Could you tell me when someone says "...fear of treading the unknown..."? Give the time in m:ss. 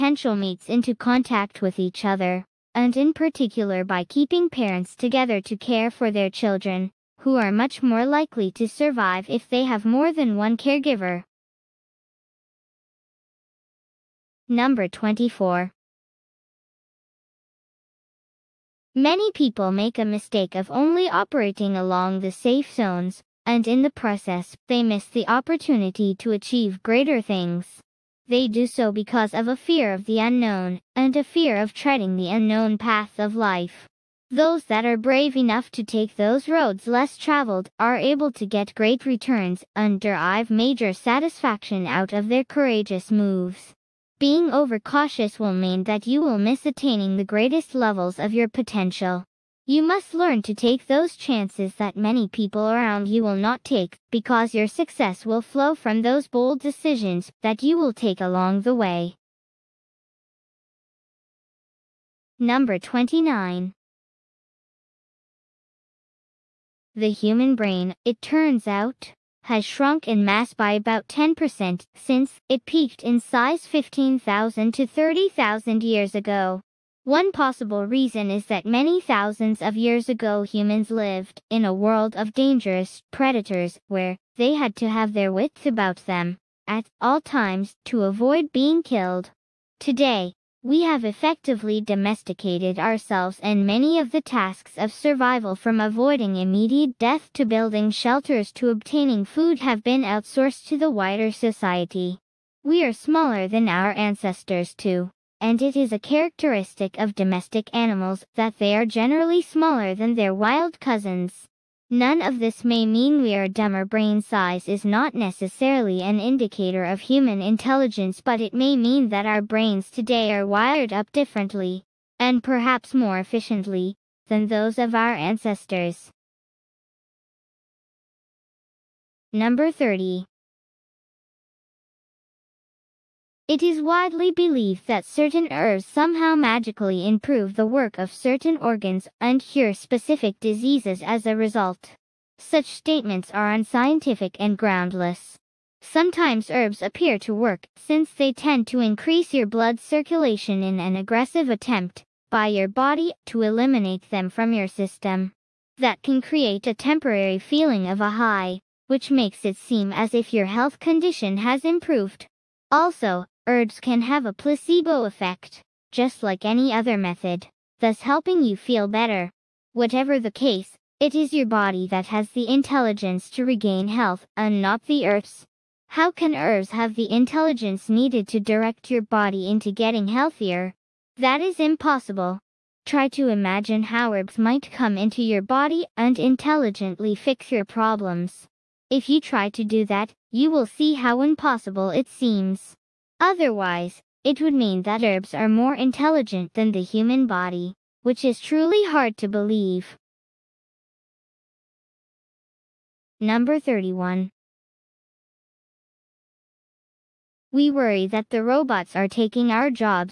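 0:31.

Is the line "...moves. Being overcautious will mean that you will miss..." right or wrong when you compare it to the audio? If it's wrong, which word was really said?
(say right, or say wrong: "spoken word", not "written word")
right.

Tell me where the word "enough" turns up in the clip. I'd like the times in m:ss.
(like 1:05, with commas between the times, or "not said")
0:35.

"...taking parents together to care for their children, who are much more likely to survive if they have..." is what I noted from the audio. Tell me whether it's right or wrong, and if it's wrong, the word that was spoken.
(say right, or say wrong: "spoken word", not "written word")
wrong: "keeping", not "taking".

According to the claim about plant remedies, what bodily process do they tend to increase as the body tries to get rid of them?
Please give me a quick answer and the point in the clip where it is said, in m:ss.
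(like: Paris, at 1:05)
blood circulation, at 2:29.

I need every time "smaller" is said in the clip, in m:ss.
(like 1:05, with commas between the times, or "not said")
1:42, 1:49.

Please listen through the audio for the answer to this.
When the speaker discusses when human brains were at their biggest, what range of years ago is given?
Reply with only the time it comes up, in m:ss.
1:13.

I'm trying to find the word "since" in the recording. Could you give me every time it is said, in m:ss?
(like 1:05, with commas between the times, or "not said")
1:11, 2:27.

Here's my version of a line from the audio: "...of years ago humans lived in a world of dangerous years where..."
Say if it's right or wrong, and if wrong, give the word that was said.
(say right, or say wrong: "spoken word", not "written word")
wrong: "predators", not "years".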